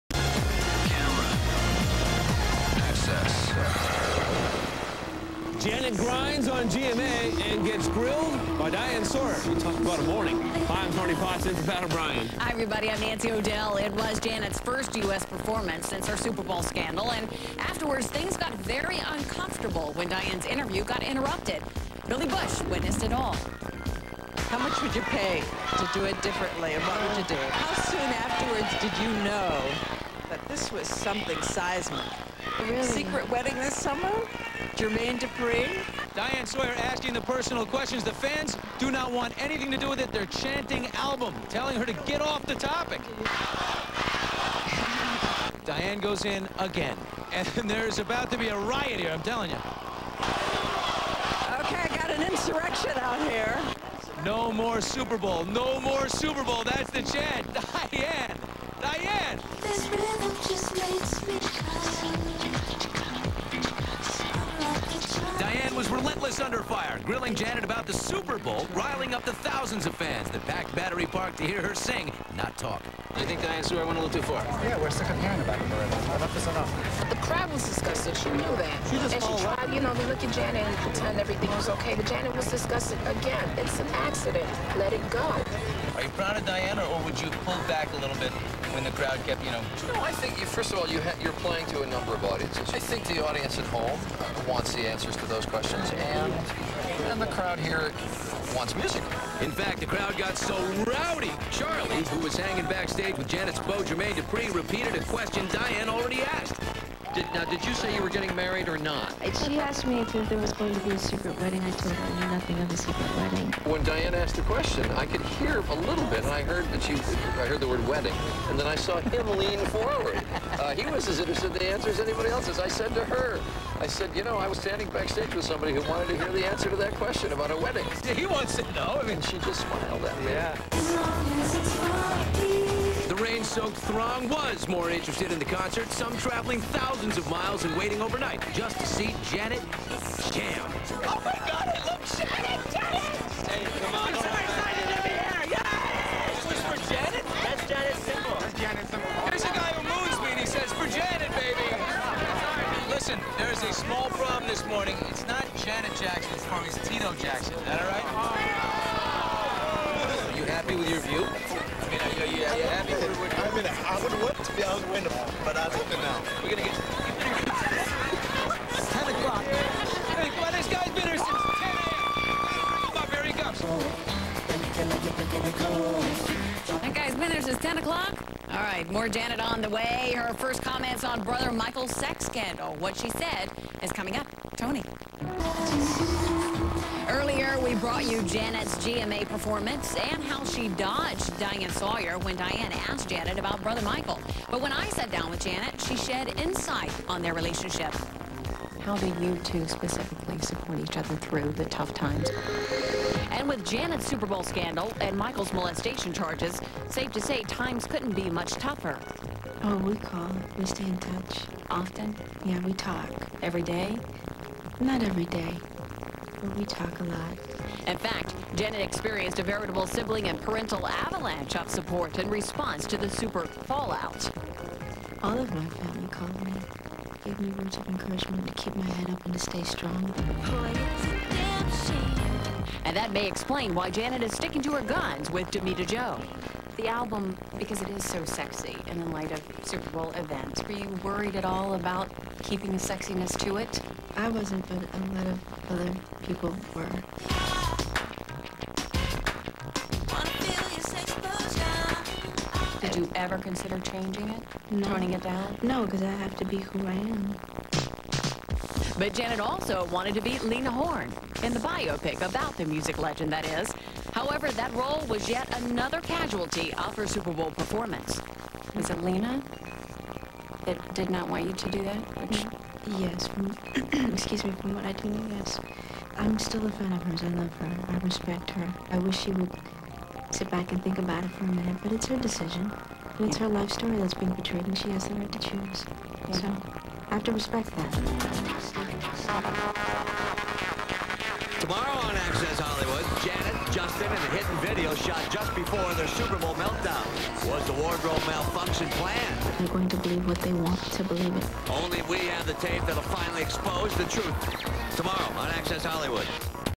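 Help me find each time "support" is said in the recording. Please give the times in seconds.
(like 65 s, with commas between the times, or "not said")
200 s, 221 s.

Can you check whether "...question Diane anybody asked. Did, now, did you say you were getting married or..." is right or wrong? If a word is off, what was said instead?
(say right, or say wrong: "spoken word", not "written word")
wrong: "already", not "anybody".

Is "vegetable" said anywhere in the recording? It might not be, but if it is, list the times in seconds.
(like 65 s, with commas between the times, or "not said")
not said.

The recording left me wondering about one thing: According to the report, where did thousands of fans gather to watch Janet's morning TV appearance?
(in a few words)
Battery Park.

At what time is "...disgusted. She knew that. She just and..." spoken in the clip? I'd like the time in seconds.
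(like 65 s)
77 s.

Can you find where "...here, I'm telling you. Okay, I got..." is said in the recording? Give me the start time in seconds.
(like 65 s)
48 s.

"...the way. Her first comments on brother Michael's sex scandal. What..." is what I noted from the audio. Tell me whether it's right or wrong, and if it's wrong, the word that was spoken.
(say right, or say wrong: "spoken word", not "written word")
right.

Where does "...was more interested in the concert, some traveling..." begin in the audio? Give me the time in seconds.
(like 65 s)
134 s.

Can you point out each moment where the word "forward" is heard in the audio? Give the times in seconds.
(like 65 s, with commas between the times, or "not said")
119 s.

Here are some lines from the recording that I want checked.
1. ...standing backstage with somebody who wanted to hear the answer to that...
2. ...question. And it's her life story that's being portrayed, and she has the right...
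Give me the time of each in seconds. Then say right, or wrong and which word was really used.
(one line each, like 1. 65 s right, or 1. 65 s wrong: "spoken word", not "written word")
1. 124 s right
2. 282 s wrong: "decision", not "question".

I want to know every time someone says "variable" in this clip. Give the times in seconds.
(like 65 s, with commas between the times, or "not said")
not said.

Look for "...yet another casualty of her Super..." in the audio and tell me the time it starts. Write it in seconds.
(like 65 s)
265 s.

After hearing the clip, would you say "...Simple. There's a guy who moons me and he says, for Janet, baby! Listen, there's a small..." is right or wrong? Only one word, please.
right.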